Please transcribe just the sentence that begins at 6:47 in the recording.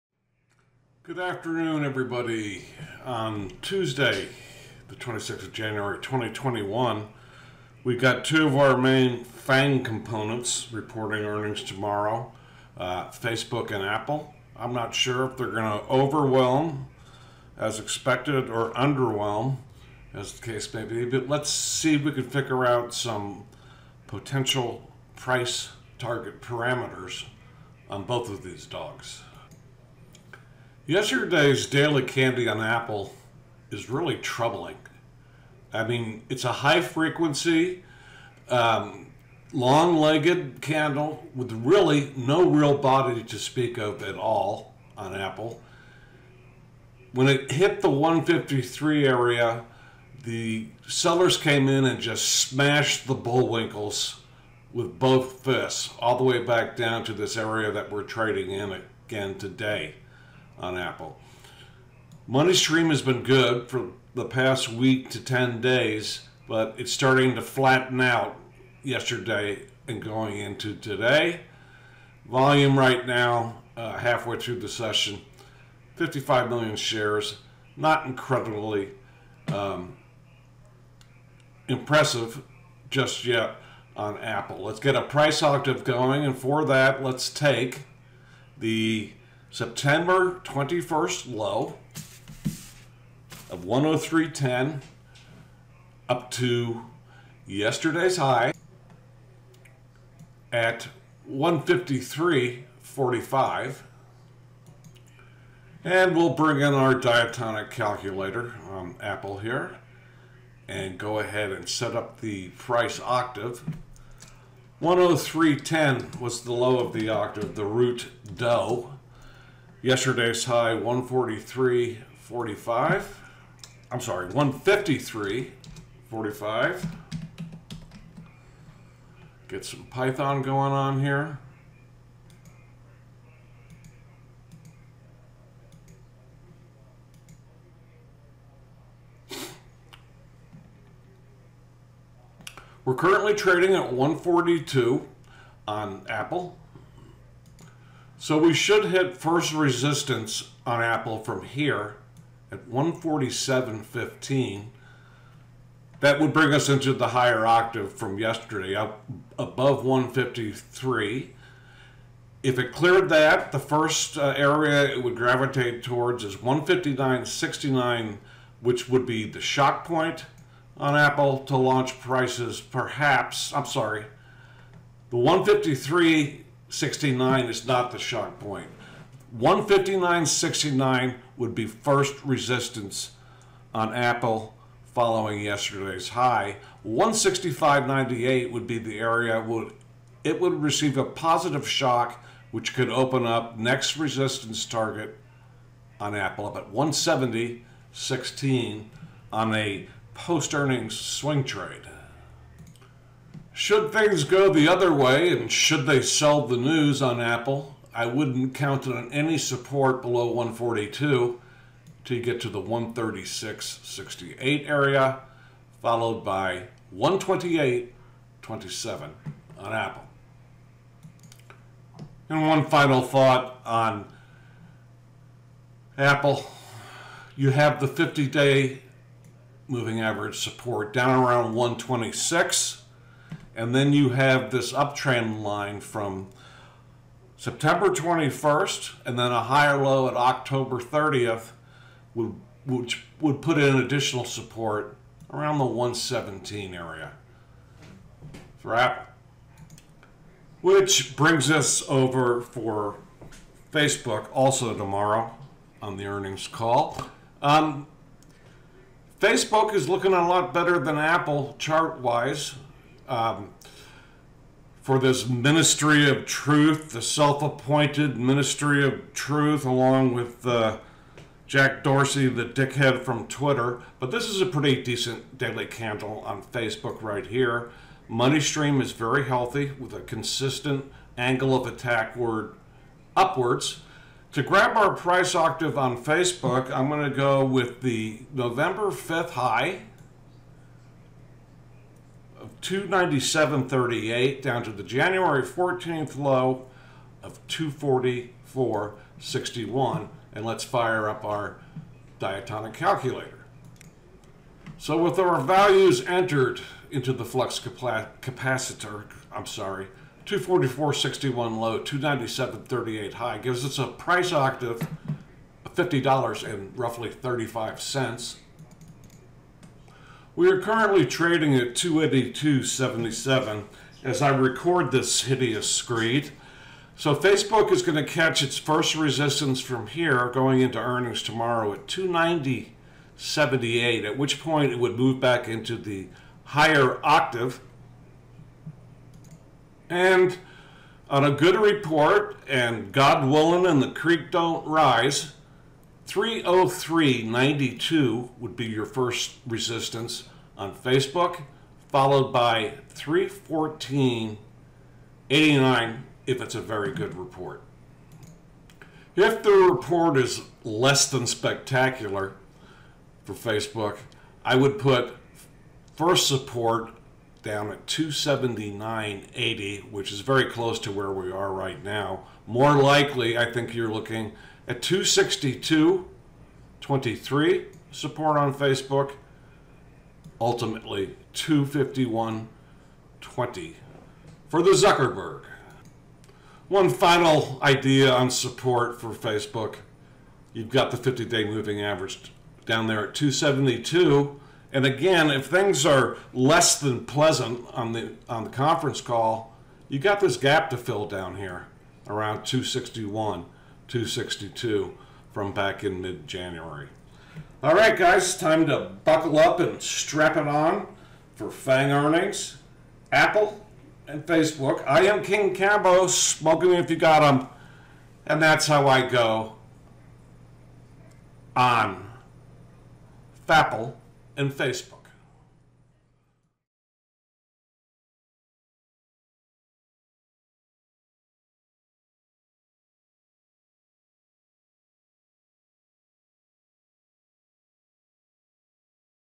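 All right, guys, time to buckle up and strap it on for FAANG earnings, Apple, and Facebook.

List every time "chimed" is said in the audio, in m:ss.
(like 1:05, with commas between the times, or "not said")
not said.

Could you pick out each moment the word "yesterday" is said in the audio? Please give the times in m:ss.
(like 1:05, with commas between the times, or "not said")
0:30, 1:08, 1:37, 1:59, 2:38, 3:05.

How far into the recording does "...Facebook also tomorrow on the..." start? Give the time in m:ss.
4:13.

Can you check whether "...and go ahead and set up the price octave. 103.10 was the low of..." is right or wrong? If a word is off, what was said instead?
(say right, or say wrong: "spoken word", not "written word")
right.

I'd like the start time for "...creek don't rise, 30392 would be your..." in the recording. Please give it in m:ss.
5:43.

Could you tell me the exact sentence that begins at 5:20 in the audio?
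We are currently trading at 282.77 as I record this hideous screed.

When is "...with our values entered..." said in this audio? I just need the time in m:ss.
5:05.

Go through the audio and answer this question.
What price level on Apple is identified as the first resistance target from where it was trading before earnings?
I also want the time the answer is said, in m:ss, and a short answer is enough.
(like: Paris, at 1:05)
147.15, at 2:32.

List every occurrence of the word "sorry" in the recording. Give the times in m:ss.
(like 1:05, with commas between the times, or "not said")
2:03, 2:53, 5:09.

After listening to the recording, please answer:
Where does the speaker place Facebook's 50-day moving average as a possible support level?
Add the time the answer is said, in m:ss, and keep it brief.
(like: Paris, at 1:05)
272, at 6:33.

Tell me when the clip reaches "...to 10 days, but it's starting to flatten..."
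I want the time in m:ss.
1:05.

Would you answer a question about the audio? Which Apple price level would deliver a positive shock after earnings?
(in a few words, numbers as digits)
165.98.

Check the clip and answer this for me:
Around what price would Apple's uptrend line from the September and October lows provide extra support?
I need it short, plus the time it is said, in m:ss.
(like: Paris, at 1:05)
117, at 4:05.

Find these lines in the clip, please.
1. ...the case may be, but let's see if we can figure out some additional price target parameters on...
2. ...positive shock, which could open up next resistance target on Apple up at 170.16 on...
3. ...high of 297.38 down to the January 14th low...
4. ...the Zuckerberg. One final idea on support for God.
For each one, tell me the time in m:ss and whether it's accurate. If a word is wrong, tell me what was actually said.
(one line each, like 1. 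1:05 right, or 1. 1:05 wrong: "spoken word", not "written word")
1. 0:20 wrong: "potential", not "additional"
2. 3:11 right
3. 4:49 right
4. 6:24 wrong: "Facebook", not "God".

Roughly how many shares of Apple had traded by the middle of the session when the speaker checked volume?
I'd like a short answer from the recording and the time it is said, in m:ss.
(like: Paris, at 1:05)
55 million, at 1:15.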